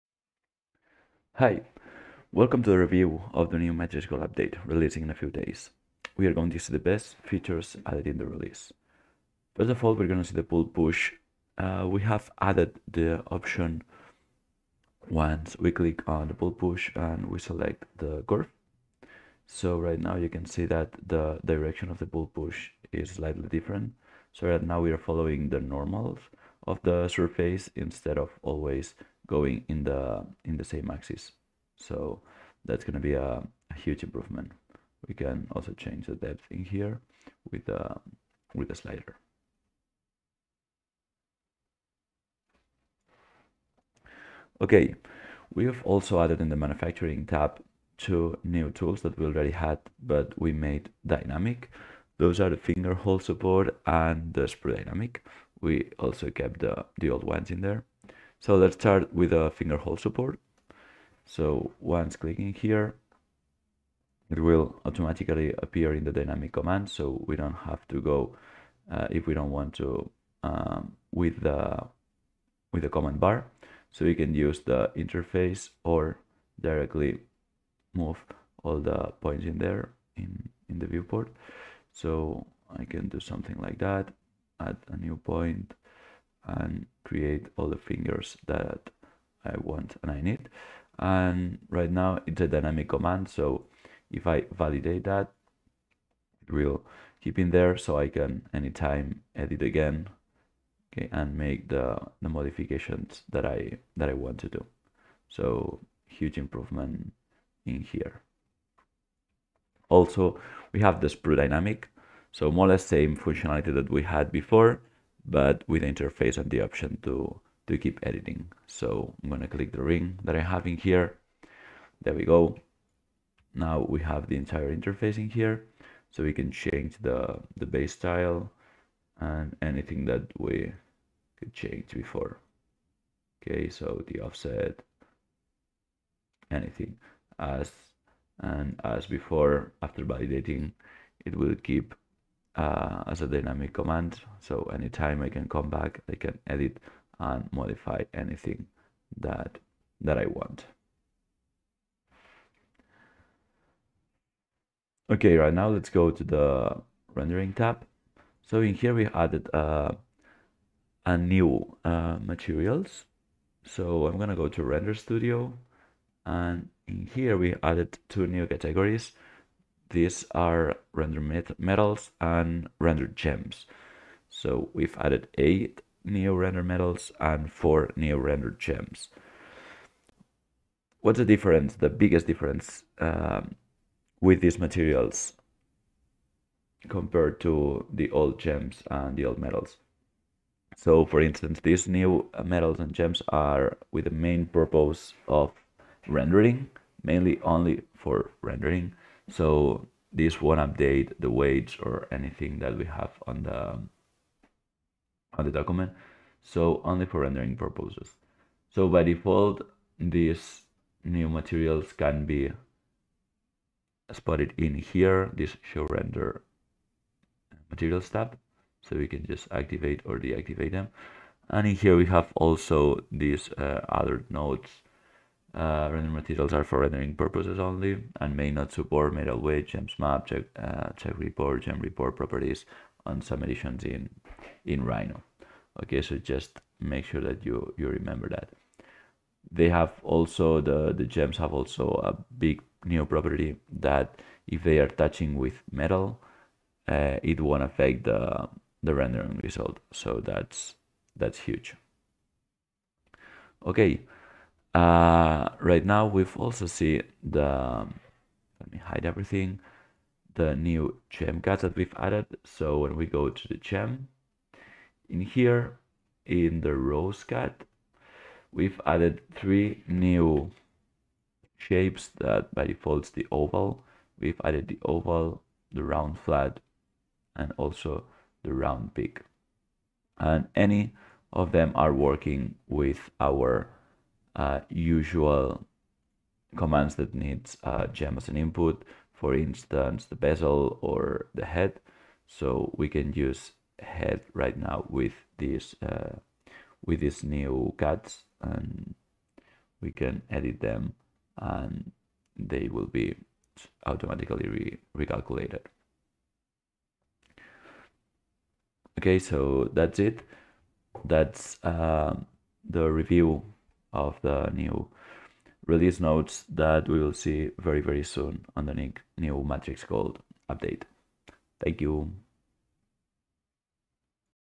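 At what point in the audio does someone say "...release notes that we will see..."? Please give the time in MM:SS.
05:15.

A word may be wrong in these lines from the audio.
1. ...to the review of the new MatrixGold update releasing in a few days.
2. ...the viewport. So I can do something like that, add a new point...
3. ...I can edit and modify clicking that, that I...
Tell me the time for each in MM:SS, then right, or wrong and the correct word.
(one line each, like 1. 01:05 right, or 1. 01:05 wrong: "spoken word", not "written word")
1. 00:02 right
2. 01:20 right
3. 02:26 wrong: "anything", not "clicking".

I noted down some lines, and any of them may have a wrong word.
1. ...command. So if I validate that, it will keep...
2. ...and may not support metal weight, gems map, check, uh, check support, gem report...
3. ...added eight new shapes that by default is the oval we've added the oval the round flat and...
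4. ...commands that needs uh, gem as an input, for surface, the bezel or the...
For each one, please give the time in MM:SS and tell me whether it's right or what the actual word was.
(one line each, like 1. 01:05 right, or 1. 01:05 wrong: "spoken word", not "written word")
1. 01:32 right
2. 03:48 wrong: "report", not "support"
3. 04:28 wrong: "three", not "eight"
4. 04:46 wrong: "instance", not "surface".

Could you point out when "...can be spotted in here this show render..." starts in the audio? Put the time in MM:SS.
03:31.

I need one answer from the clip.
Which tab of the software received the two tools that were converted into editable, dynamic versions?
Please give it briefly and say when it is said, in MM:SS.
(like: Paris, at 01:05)
manufacturing tab, at 00:46.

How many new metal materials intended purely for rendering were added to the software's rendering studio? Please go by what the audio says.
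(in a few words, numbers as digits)
8.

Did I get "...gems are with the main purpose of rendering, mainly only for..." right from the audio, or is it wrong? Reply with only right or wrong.
right.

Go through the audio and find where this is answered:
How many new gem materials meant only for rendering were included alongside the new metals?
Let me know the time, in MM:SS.
02:57.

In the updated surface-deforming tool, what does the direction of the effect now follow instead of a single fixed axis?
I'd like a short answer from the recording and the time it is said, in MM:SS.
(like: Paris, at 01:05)
normals of the surface, at 00:25.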